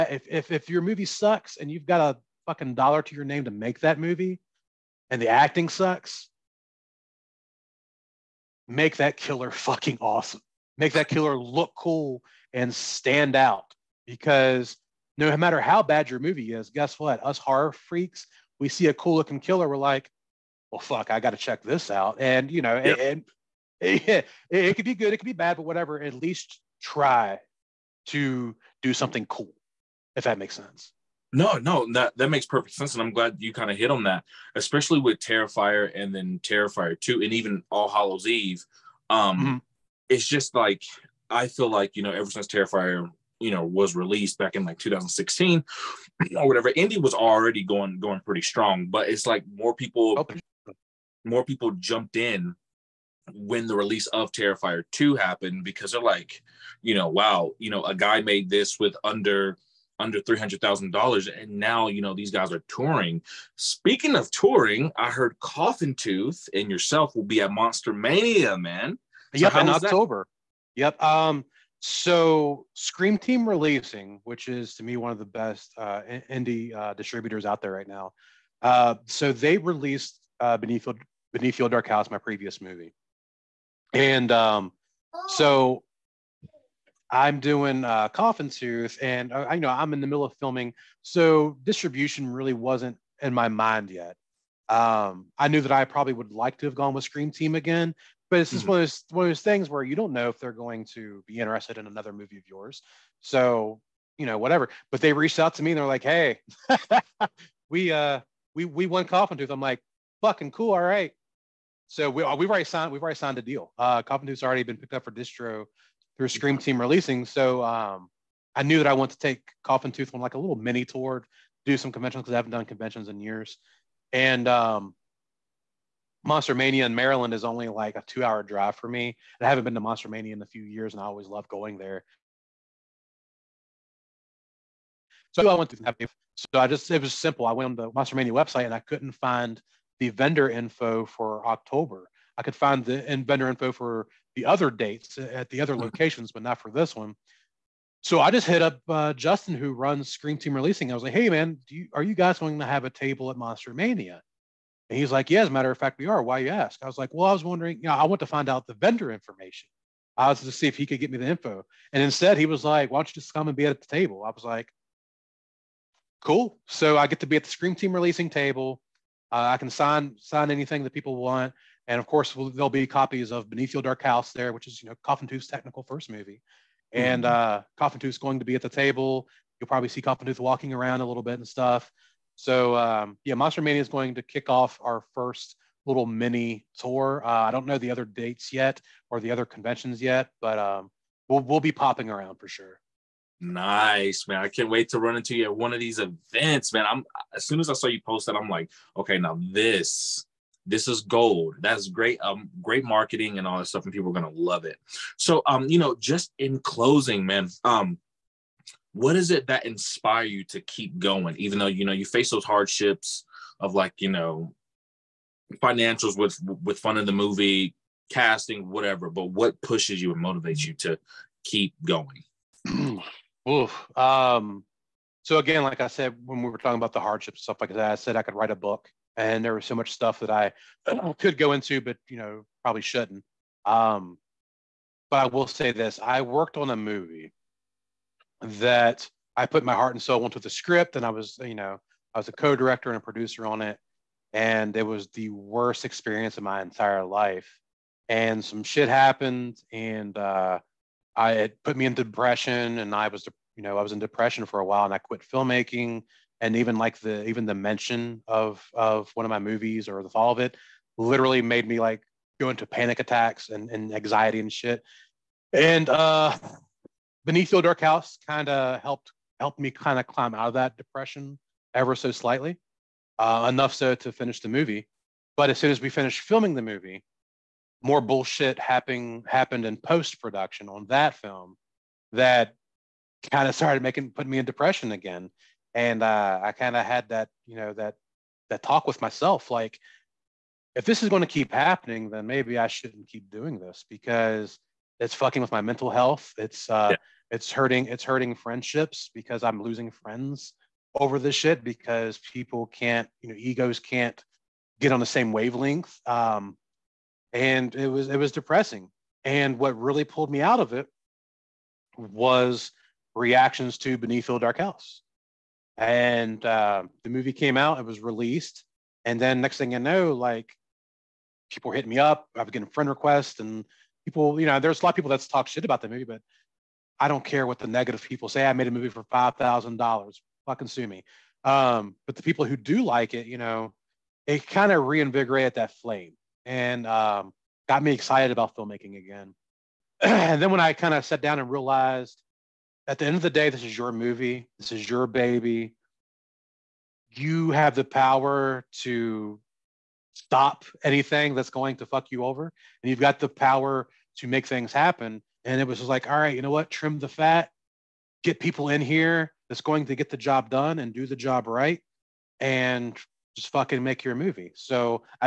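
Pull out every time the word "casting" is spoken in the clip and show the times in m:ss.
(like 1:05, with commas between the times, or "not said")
3:38.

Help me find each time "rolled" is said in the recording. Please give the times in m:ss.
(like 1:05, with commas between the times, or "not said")
not said.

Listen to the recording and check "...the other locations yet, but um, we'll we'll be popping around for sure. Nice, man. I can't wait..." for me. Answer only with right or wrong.
wrong.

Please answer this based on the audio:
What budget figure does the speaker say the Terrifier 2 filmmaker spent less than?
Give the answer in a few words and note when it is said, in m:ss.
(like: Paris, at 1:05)
300,000 dollars, at 1:00.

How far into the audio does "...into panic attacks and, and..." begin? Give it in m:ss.
4:22.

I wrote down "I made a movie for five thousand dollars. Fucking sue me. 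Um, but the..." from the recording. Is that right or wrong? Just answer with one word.
right.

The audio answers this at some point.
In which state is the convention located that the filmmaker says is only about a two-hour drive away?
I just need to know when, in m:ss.
2:06.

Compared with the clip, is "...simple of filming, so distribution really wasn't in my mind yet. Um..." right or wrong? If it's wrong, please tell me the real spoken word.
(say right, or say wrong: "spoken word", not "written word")
wrong: "middle", not "simple".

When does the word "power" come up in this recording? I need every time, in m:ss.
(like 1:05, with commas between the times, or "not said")
5:47, 5:53.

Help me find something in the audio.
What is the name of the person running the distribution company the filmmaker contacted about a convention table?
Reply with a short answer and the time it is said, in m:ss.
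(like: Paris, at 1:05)
Justin, at 2:29.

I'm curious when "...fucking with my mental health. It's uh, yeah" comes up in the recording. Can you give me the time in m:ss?
4:55.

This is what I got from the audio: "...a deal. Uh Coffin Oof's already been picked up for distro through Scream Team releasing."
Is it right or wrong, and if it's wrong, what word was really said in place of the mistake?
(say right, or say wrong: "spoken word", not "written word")
wrong: "Tooth", not "Oof".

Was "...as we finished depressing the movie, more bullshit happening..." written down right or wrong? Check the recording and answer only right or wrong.
wrong.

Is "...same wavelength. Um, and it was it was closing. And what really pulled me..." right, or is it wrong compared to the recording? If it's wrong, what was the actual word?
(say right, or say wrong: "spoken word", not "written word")
wrong: "depressing", not "closing".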